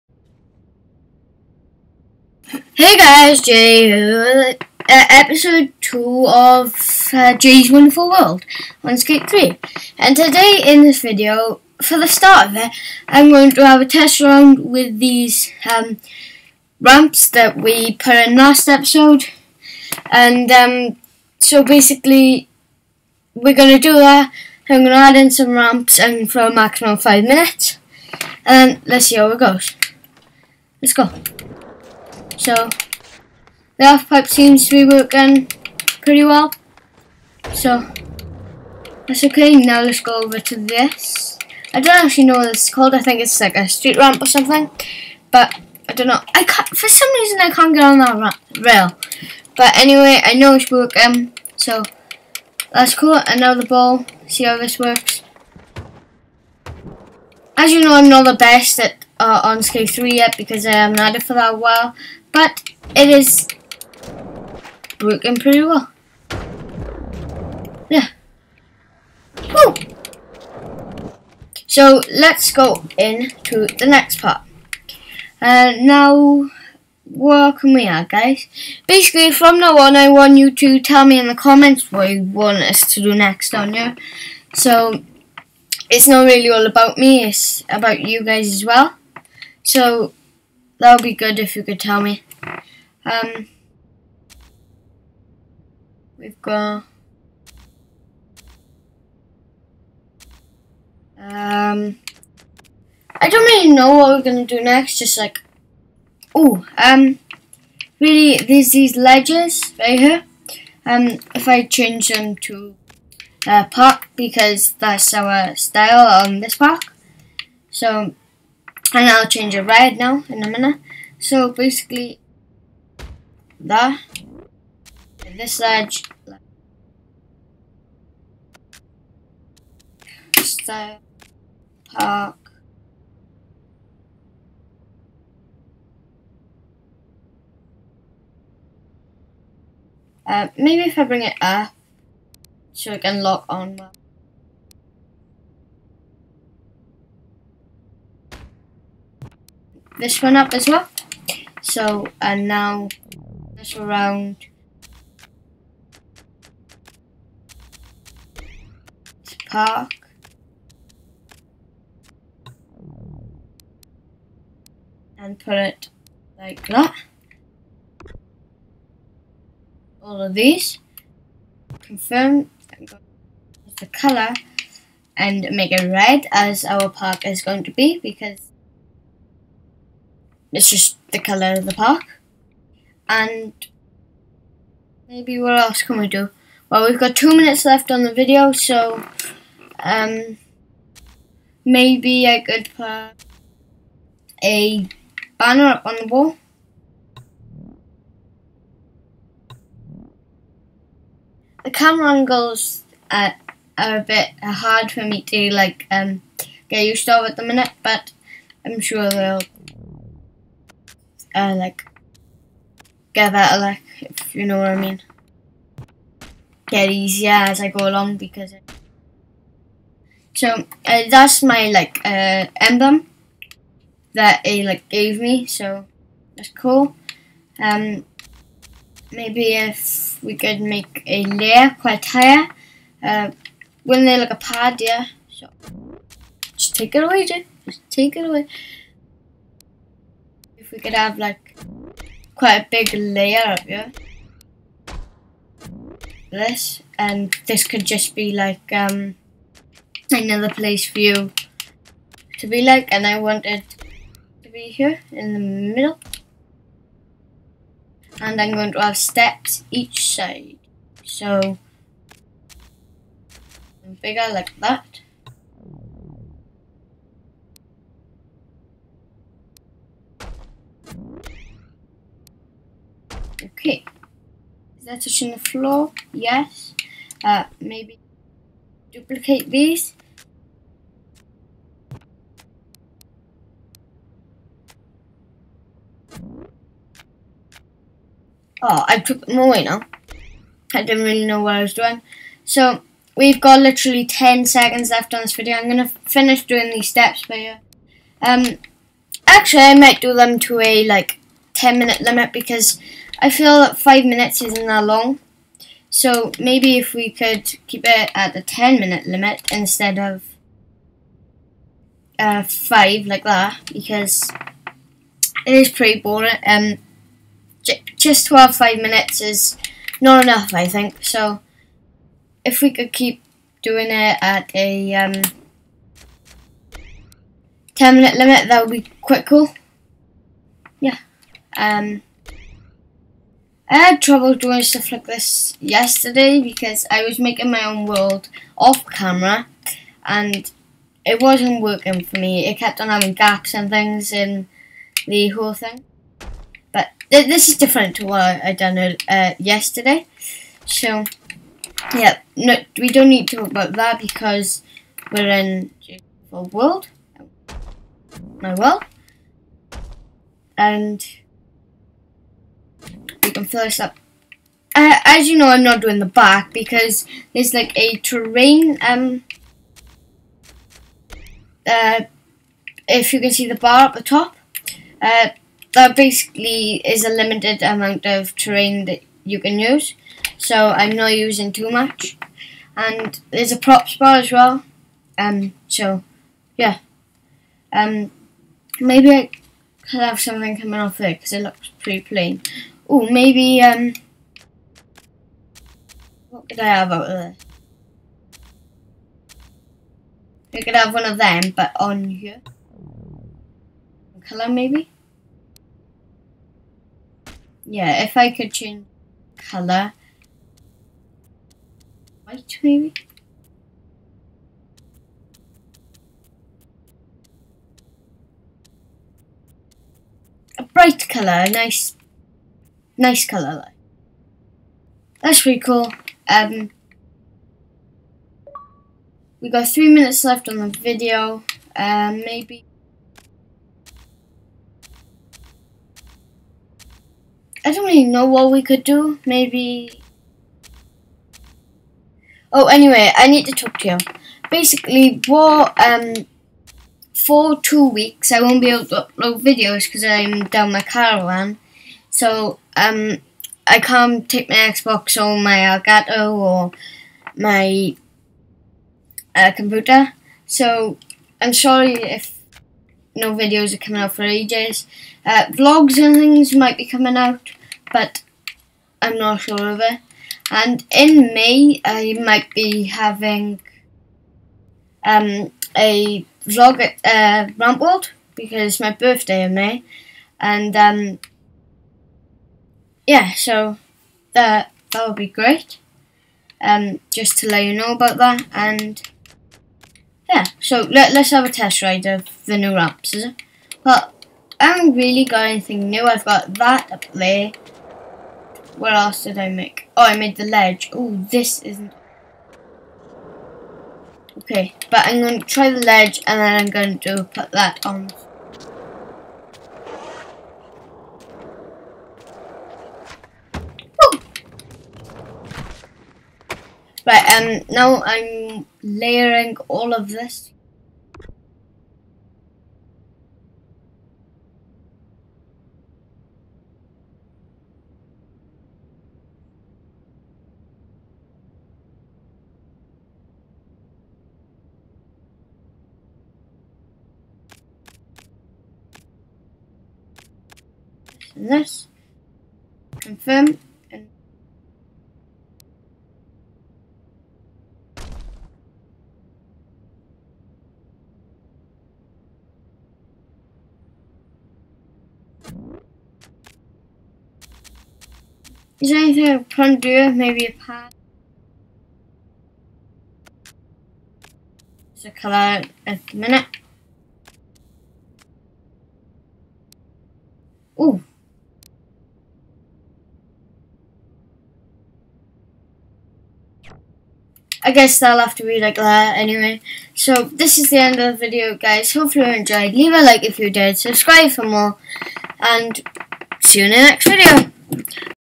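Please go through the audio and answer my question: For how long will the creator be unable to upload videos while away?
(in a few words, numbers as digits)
2 weeks.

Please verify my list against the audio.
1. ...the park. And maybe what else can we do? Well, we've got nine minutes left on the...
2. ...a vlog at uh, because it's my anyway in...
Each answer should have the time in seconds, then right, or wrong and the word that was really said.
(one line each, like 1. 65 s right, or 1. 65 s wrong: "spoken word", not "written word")
1. 181 s wrong: "two", not "nine"
2. 475 s wrong: "birthday", not "anyway".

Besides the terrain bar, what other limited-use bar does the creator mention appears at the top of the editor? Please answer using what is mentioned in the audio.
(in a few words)
Props bar.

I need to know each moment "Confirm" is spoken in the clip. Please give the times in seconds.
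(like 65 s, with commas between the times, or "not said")
171 s, 542 s.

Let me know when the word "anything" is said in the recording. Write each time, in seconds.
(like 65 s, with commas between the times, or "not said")
495 s, 558 s.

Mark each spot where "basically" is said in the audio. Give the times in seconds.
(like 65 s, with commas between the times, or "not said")
21 s, 78 s, 121 s, 375 s, 444 s.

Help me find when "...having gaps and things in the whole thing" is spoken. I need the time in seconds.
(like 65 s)
342 s.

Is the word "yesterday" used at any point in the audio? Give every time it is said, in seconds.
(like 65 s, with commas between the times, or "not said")
335 s, 349 s.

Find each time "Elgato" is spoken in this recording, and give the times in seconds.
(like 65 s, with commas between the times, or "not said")
455 s.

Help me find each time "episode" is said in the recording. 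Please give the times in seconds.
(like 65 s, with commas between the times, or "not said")
4 s, 18 s.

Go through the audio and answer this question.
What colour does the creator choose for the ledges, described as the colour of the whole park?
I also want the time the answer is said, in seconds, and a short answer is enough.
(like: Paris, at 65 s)
Red, at 175 s.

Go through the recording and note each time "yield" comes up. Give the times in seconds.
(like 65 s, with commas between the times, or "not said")
not said.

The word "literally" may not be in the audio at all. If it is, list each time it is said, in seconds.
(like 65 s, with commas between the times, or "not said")
293 s.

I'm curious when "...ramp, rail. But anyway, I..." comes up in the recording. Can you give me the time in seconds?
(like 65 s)
48 s.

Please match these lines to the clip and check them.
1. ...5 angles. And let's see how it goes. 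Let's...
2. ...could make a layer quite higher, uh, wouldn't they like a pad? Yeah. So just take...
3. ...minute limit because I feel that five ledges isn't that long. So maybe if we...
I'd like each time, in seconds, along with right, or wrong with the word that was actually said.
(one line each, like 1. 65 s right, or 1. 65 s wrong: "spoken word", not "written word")
1. 26 s wrong: "minutes", not "angles"
2. 230 s right
3. 301 s wrong: "minutes", not "ledges".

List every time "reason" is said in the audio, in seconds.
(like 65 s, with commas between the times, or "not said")
47 s.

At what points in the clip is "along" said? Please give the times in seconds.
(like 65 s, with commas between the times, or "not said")
217 s.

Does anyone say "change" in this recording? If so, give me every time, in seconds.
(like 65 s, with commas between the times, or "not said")
111 s, 119 s, 408 s.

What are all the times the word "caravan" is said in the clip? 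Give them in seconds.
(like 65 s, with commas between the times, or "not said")
450 s.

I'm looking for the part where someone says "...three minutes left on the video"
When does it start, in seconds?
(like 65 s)
429 s.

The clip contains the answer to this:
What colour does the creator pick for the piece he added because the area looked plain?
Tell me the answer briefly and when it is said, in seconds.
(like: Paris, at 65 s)
White, at 412 s.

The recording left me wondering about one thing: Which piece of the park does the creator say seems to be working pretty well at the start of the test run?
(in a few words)
The half pipe.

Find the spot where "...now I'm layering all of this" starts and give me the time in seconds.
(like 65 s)
517 s.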